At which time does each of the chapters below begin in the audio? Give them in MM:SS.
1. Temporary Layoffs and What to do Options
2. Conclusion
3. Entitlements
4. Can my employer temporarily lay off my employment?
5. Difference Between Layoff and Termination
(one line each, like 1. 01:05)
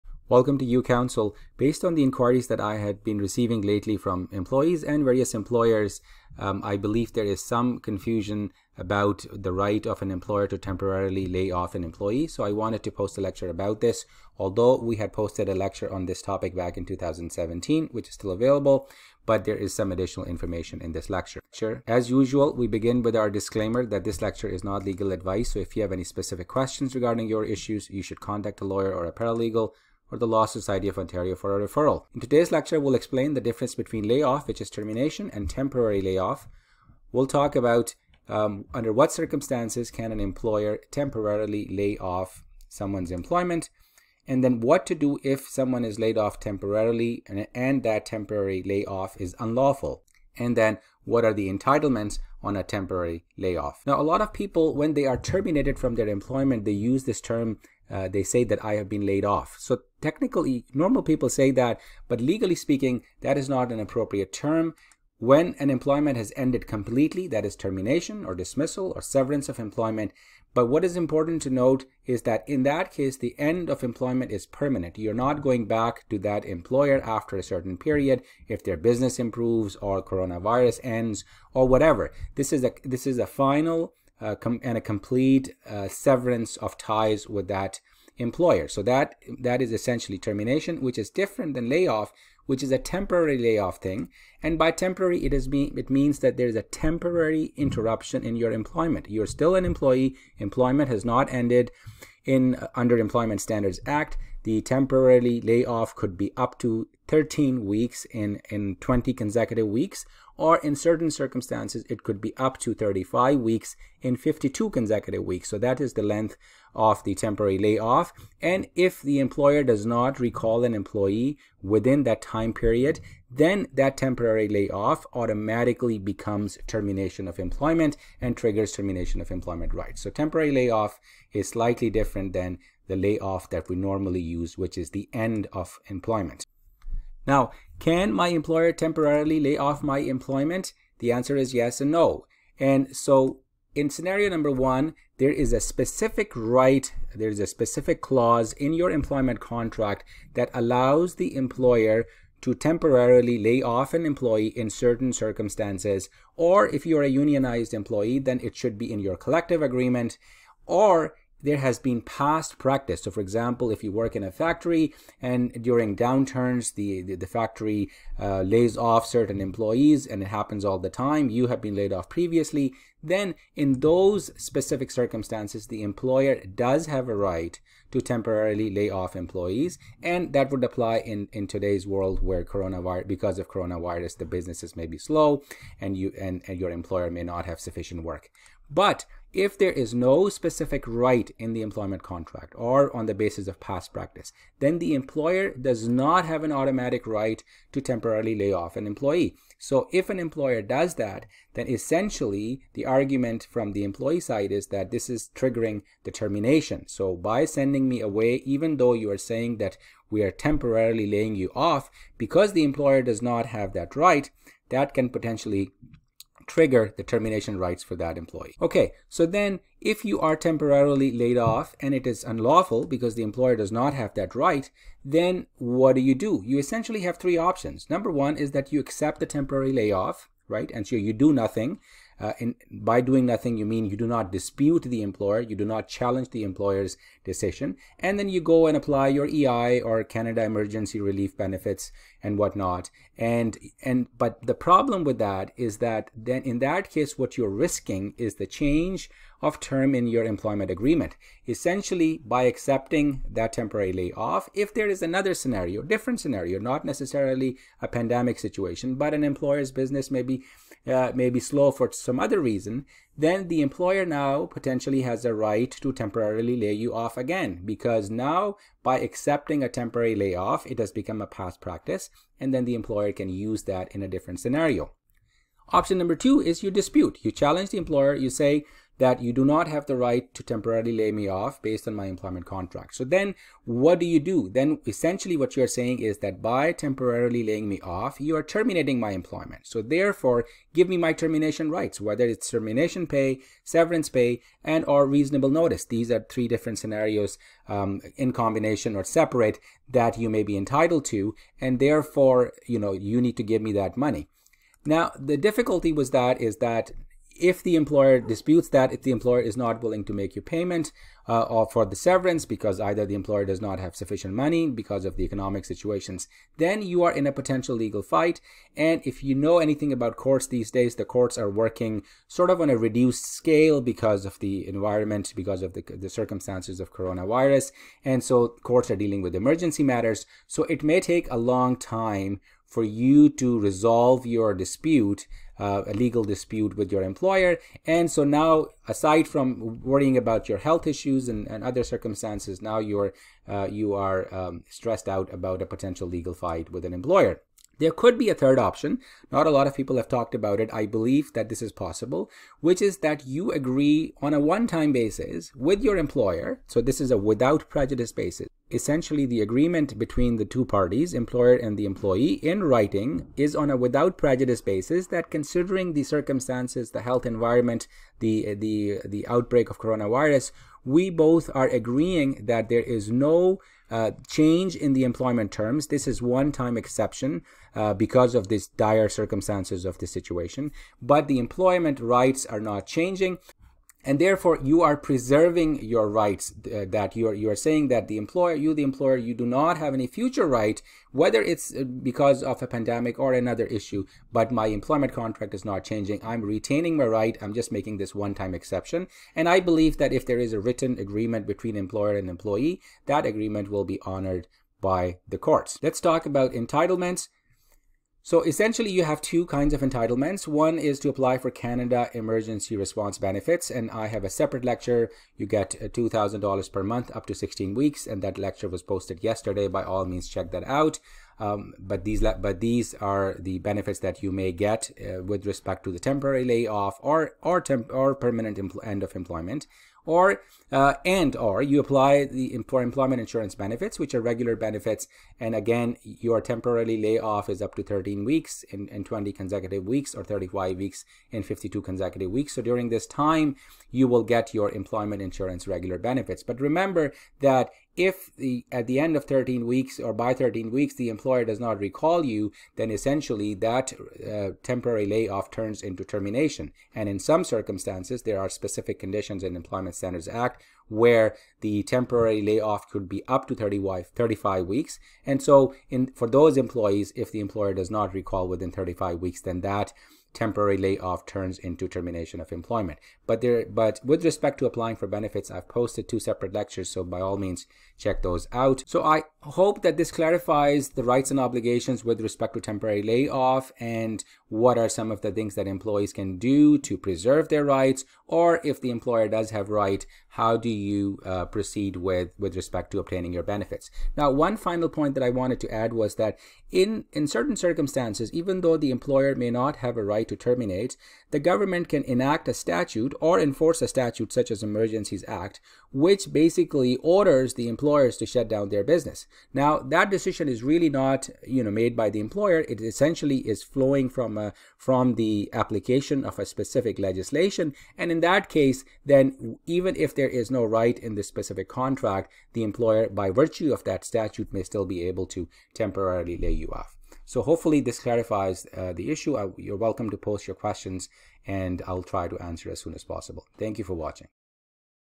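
1. 03:40
2. 08:00
3. 06:47
4. 02:18
5. 00:33.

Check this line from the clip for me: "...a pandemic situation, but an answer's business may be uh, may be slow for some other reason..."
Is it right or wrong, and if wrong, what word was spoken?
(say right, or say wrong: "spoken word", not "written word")
wrong: "employer", not "answer".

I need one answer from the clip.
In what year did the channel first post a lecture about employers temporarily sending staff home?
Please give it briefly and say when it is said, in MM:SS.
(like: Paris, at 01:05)
2017, at 00:16.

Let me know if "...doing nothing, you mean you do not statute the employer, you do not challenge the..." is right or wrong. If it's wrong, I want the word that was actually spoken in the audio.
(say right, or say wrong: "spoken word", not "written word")
wrong: "dispute", not "statute".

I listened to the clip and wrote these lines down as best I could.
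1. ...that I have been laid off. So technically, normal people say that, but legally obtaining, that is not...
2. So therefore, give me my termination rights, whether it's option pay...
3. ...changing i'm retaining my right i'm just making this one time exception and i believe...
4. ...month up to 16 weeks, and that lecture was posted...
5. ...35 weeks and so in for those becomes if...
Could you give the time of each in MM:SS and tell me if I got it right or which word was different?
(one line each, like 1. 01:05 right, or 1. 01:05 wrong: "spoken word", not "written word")
1. 00:58 wrong: "speaking", not "obtaining"
2. 04:49 wrong: "termination", not "option"
3. 06:35 right
4. 06:56 right
5. 07:44 wrong: "employees", not "becomes".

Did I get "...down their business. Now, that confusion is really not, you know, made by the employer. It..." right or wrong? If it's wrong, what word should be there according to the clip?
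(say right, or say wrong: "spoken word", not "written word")
wrong: "decision", not "confusion".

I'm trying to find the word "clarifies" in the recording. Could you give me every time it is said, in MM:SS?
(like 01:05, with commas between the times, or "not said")
08:00, 08:47.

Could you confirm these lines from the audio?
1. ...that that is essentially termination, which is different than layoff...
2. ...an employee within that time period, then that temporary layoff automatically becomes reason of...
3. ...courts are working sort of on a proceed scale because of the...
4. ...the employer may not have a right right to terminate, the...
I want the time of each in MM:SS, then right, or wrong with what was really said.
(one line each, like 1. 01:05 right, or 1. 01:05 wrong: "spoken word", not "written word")
1. 01:28 right
2. 02:00 wrong: "termination", not "reason"
3. 05:21 wrong: "reduced", not "proceed"
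4. 08:18 right.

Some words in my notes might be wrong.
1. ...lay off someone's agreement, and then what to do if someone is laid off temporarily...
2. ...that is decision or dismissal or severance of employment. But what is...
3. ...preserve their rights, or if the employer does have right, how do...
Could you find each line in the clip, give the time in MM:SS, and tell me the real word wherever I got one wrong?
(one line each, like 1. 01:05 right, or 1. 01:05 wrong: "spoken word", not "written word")
1. 00:41 wrong: "employment", not "agreement"
2. 01:07 wrong: "termination", not "decision"
3. 08:06 right.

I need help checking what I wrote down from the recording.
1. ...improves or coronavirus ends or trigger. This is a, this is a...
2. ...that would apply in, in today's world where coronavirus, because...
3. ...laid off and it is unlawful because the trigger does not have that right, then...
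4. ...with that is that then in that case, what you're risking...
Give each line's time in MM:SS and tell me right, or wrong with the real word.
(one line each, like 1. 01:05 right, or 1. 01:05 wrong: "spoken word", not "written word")
1. 01:19 wrong: "whatever", not "trigger"
2. 03:00 right
3. 03:41 wrong: "employer", not "trigger"
4. 04:05 right.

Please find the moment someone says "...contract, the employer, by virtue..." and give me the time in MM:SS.
08:41.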